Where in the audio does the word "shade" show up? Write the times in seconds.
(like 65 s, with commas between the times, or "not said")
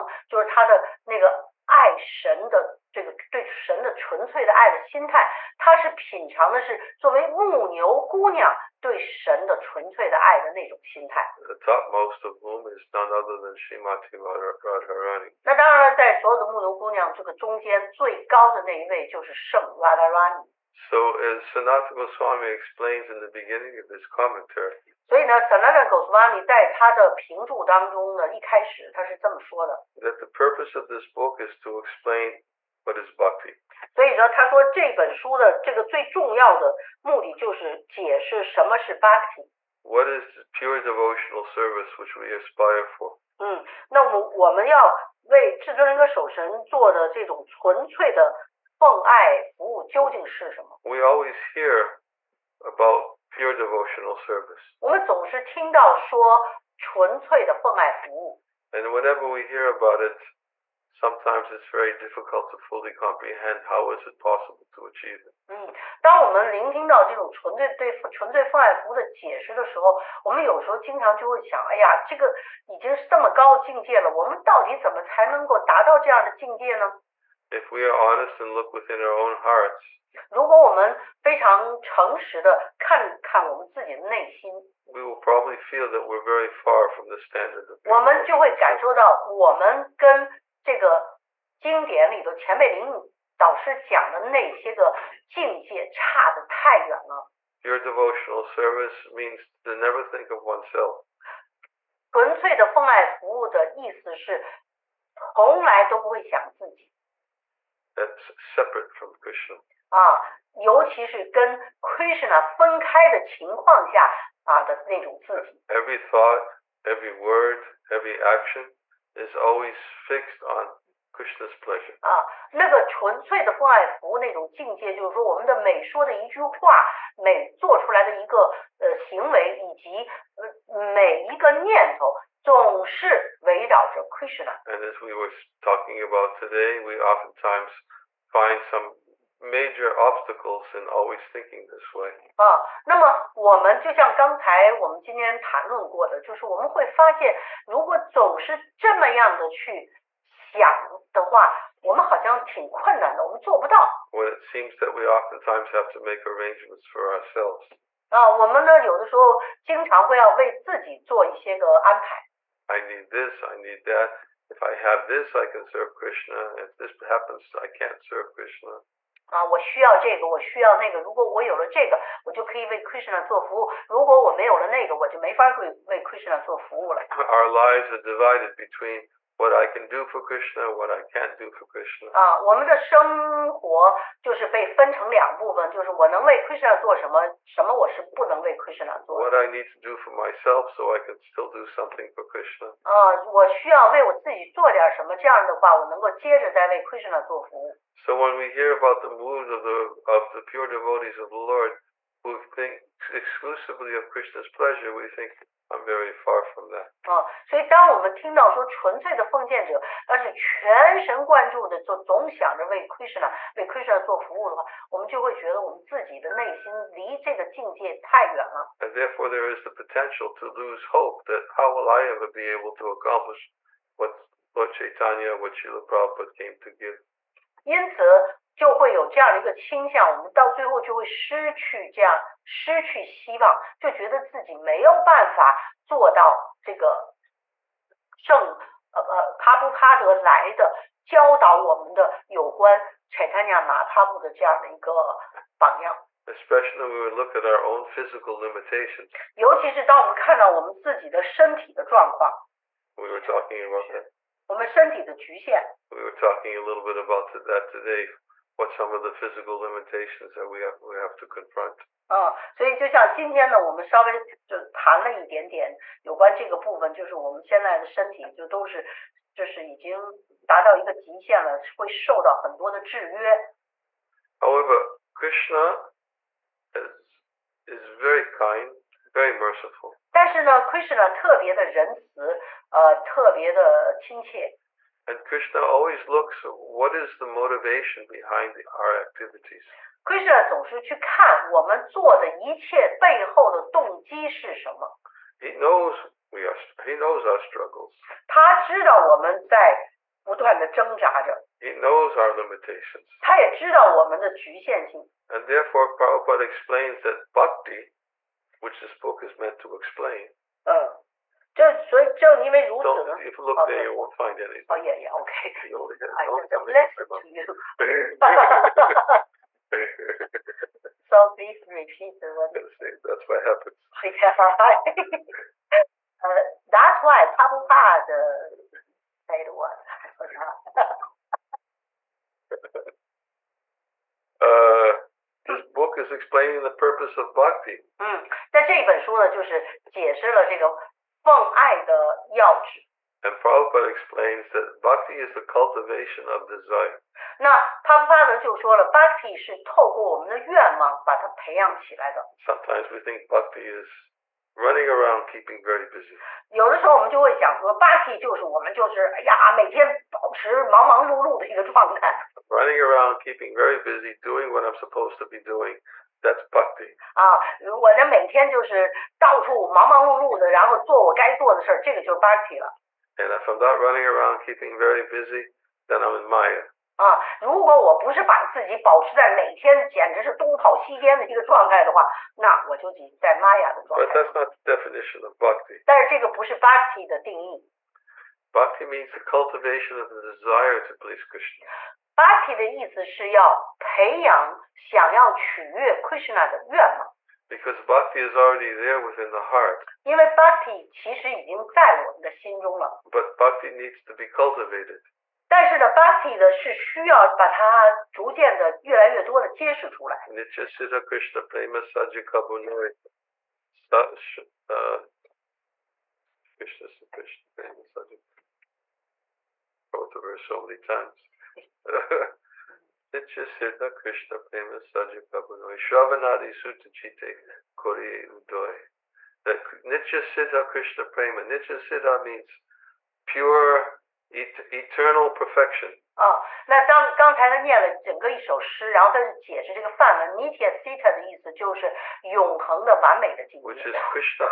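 not said.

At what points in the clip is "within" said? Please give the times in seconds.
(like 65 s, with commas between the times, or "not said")
78 s, 399 s.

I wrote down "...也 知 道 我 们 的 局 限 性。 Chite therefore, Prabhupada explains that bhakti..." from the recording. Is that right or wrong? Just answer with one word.
wrong.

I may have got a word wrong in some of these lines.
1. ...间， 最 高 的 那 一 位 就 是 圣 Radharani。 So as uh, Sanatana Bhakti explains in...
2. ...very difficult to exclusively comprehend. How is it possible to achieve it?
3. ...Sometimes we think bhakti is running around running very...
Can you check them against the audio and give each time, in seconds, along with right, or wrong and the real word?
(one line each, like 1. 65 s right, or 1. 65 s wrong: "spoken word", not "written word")
1. 17 s wrong: "Goswami", not "Bhakti"
2. 61 s wrong: "fully", not "exclusively"
3. 352 s wrong: "keeping", not "running".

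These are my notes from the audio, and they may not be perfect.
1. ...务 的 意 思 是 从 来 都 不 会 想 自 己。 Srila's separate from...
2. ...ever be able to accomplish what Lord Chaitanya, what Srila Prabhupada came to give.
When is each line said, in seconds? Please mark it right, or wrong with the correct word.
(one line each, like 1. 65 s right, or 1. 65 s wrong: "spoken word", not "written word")
1. 103 s wrong: "That", not "Srila"
2. 222 s right.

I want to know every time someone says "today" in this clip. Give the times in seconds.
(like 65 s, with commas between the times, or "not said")
136 s, 257 s.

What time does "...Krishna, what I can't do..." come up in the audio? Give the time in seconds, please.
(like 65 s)
180 s.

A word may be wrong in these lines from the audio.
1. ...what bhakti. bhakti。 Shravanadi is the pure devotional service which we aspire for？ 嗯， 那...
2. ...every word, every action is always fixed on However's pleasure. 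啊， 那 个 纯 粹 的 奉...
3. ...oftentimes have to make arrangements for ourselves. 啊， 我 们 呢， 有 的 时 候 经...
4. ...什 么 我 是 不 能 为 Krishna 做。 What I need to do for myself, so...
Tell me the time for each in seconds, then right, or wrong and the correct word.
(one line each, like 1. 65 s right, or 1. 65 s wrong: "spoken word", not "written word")
1. 32 s wrong: "What", not "Shravanadi"
2. 116 s wrong: "Krishna", not "However"
3. 155 s right
4. 187 s right.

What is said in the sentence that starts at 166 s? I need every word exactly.
If this happens, I can't serve Krishna.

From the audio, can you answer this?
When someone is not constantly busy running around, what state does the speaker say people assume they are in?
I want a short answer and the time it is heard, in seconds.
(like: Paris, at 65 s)
Maya, at 376 s.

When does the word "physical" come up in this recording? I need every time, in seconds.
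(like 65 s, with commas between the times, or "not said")
247 s, 259 s.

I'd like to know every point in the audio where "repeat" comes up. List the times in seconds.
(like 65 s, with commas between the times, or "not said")
321 s.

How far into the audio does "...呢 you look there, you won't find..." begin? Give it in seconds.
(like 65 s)
313 s.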